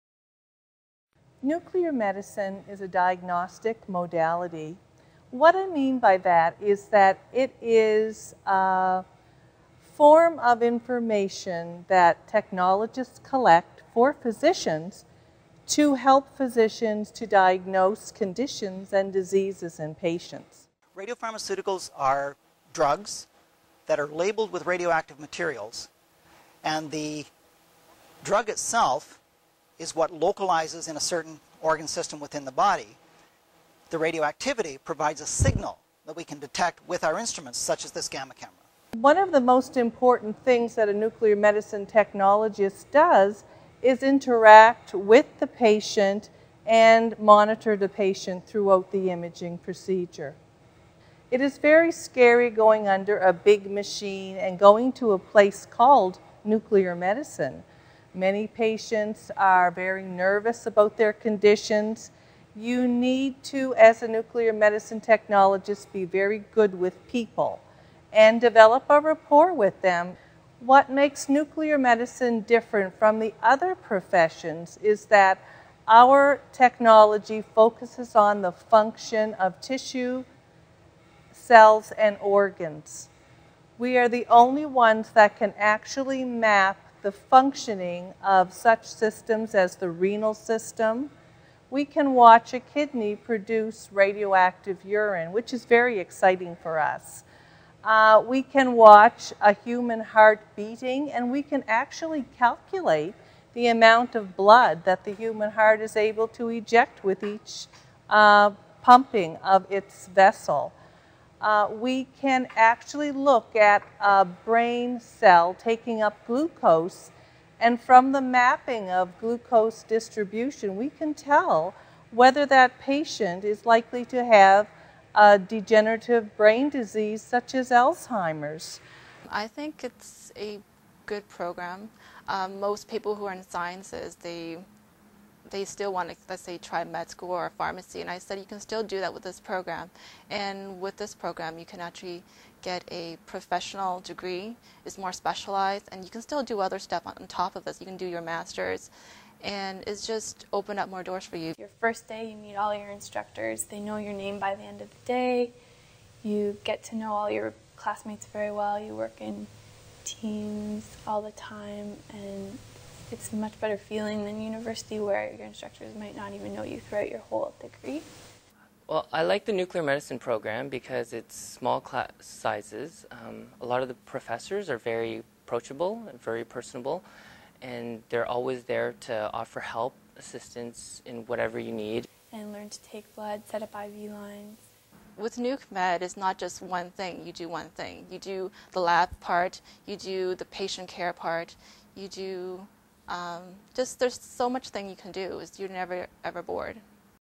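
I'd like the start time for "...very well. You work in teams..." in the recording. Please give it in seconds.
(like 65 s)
158 s.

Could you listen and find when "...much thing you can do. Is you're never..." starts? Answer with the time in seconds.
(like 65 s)
194 s.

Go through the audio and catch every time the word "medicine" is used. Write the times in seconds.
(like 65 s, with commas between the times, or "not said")
1 s, 41 s, 56 s, 64 s, 71 s, 169 s.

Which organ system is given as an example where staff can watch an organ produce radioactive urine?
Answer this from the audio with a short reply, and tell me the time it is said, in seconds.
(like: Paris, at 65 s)
renal system, at 89 s.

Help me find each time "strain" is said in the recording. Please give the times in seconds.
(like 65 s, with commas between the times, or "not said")
not said.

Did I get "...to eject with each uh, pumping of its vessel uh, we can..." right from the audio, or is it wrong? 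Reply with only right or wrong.
right.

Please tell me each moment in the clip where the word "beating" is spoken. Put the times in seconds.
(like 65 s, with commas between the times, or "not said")
100 s.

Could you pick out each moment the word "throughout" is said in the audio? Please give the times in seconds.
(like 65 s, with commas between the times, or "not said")
48 s, 166 s.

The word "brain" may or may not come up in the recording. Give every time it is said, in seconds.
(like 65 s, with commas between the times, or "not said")
114 s, 126 s.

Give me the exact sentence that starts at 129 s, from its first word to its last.
I think it's a good program.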